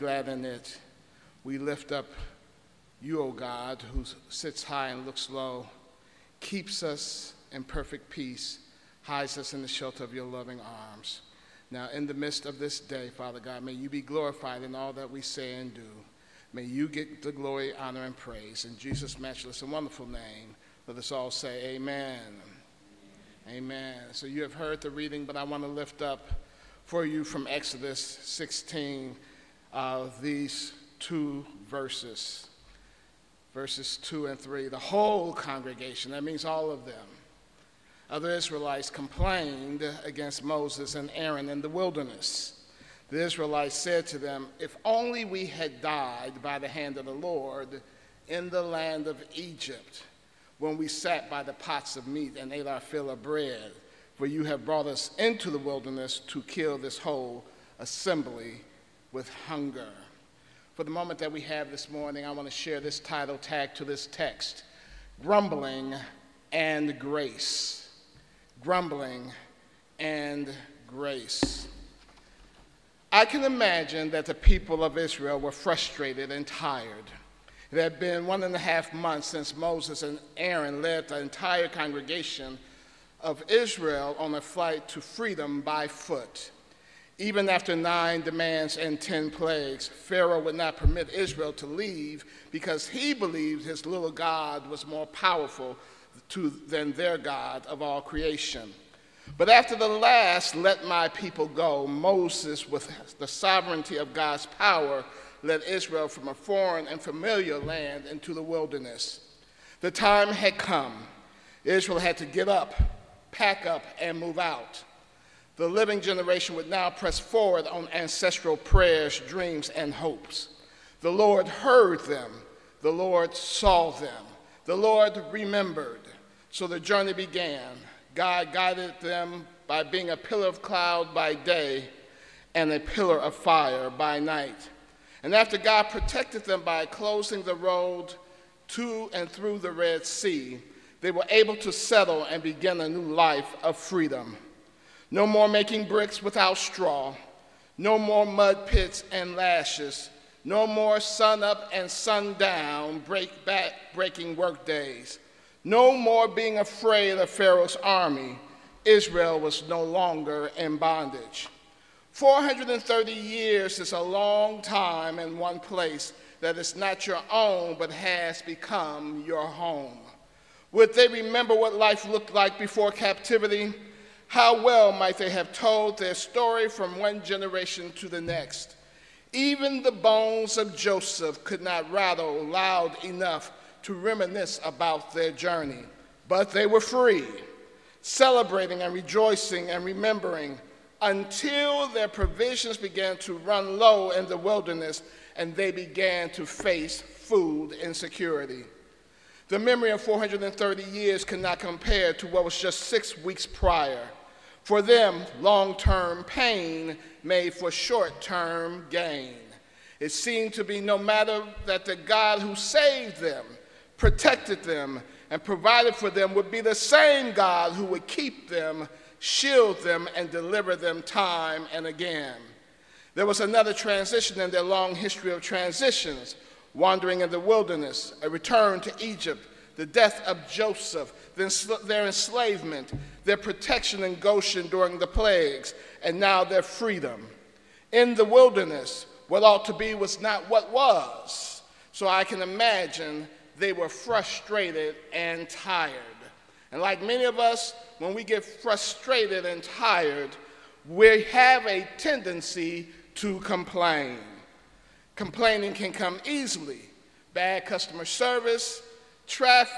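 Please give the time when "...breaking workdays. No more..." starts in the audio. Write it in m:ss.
2:33.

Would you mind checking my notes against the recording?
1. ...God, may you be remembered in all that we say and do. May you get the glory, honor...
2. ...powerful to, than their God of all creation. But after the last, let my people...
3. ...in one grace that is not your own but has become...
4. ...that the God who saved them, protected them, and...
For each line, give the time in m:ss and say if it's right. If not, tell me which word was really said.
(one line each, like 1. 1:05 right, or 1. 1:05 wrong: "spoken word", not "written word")
1. 0:13 wrong: "glorified", not "remembered"
2. 1:35 right
3. 2:45 wrong: "place", not "grace"
4. 3:31 right.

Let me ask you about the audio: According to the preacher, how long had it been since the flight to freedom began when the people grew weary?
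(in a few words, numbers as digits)
One and a half months.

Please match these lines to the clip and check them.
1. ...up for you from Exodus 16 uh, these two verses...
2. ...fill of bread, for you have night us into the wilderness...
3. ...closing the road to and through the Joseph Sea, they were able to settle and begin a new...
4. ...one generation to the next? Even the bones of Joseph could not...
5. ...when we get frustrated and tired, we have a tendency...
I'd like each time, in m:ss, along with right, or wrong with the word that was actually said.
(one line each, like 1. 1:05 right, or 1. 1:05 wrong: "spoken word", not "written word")
1. 0:26 right
2. 0:52 wrong: "brought", not "night"
3. 2:16 wrong: "Red", not "Joseph"
4. 2:56 right
5. 4:07 right.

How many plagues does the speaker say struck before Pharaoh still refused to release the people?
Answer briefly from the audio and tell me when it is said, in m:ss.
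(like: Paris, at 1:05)
10, at 1:28.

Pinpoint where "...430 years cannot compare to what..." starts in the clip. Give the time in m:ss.
3:20.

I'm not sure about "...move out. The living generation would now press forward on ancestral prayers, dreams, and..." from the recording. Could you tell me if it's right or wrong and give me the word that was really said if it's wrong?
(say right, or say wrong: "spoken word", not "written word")
right.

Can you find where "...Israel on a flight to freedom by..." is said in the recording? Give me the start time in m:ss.
1:23.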